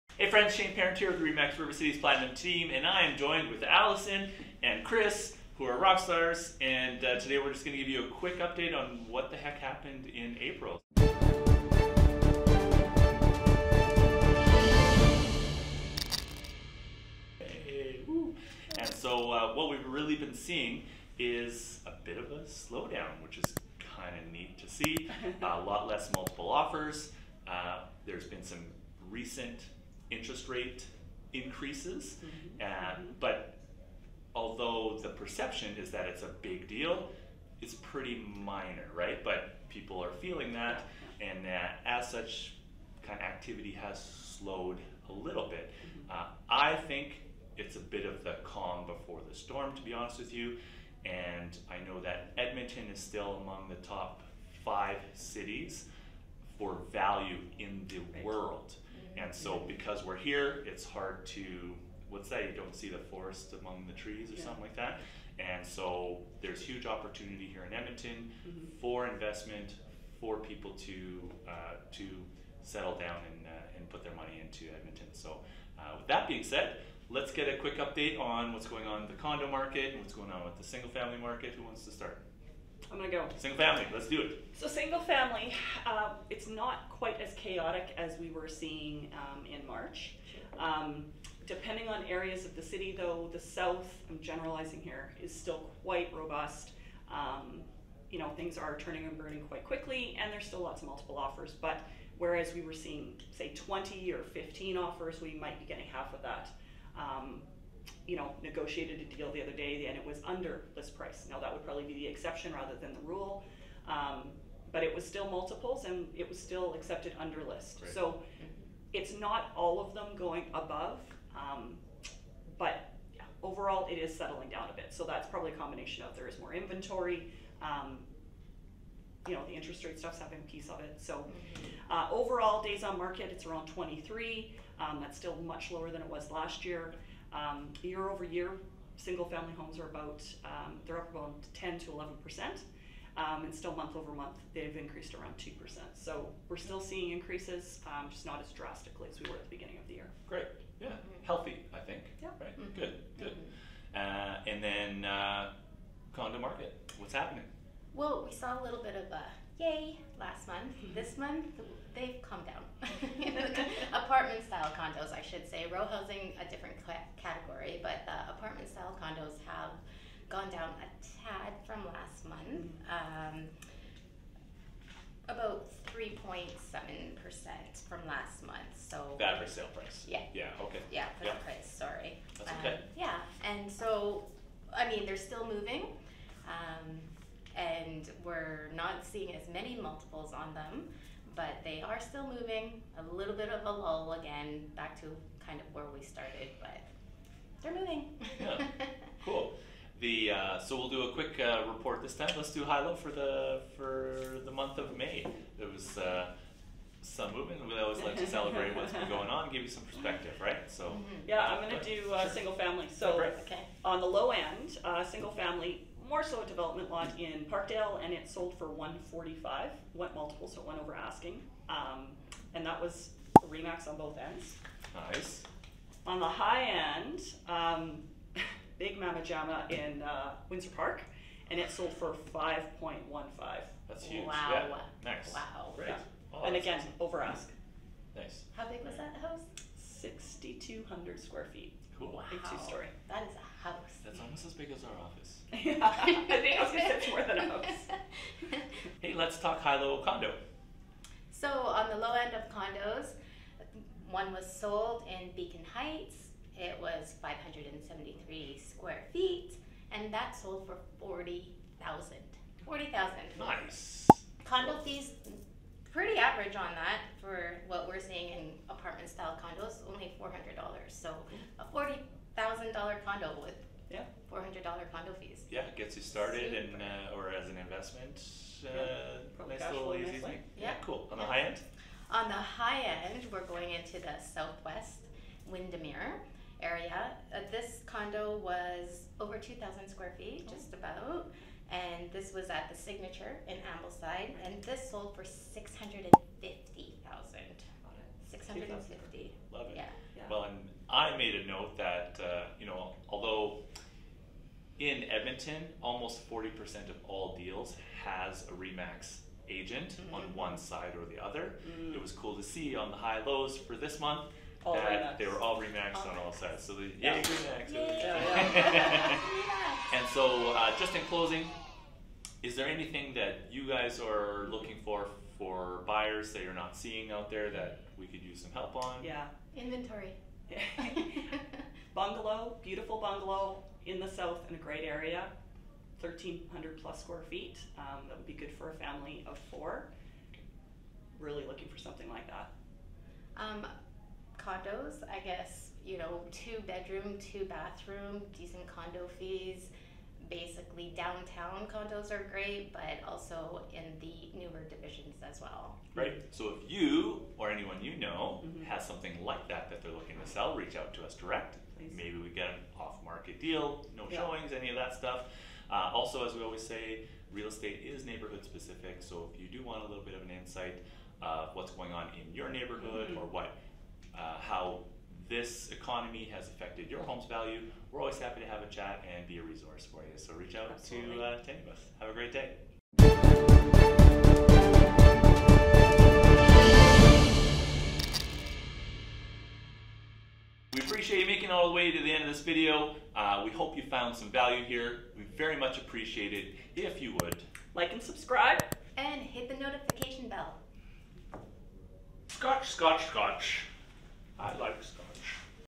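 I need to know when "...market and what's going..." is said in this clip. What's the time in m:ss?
1:19.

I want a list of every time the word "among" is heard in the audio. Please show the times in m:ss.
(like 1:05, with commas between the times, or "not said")
0:53, 1:03.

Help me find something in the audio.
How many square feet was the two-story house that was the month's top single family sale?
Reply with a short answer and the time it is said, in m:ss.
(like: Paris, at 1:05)
6,200, at 4:00.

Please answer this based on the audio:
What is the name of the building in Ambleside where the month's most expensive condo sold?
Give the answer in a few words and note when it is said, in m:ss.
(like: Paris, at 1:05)
the Signature, at 4:52.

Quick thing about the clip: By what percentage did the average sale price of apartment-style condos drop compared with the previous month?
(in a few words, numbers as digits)
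3.7%.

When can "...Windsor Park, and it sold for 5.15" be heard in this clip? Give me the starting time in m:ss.
3:50.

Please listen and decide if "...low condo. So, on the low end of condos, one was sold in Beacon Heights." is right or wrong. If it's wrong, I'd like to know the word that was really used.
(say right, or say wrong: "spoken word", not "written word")
right.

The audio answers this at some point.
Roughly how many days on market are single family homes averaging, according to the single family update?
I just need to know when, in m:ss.
2:13.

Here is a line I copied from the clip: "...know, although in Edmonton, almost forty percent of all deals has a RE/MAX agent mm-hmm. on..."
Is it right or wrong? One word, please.
right.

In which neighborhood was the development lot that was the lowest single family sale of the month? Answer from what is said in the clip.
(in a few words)
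Parkdale.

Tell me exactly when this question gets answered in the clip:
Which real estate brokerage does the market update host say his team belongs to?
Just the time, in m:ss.
0:01.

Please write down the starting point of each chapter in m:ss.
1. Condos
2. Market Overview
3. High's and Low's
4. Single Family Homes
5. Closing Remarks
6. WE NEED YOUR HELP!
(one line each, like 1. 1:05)
1. 2:35
2. 0:19
3. 3:20
4. 1:23
5. 6:05
6. 5:20.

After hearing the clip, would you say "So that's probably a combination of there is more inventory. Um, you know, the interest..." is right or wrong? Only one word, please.
right.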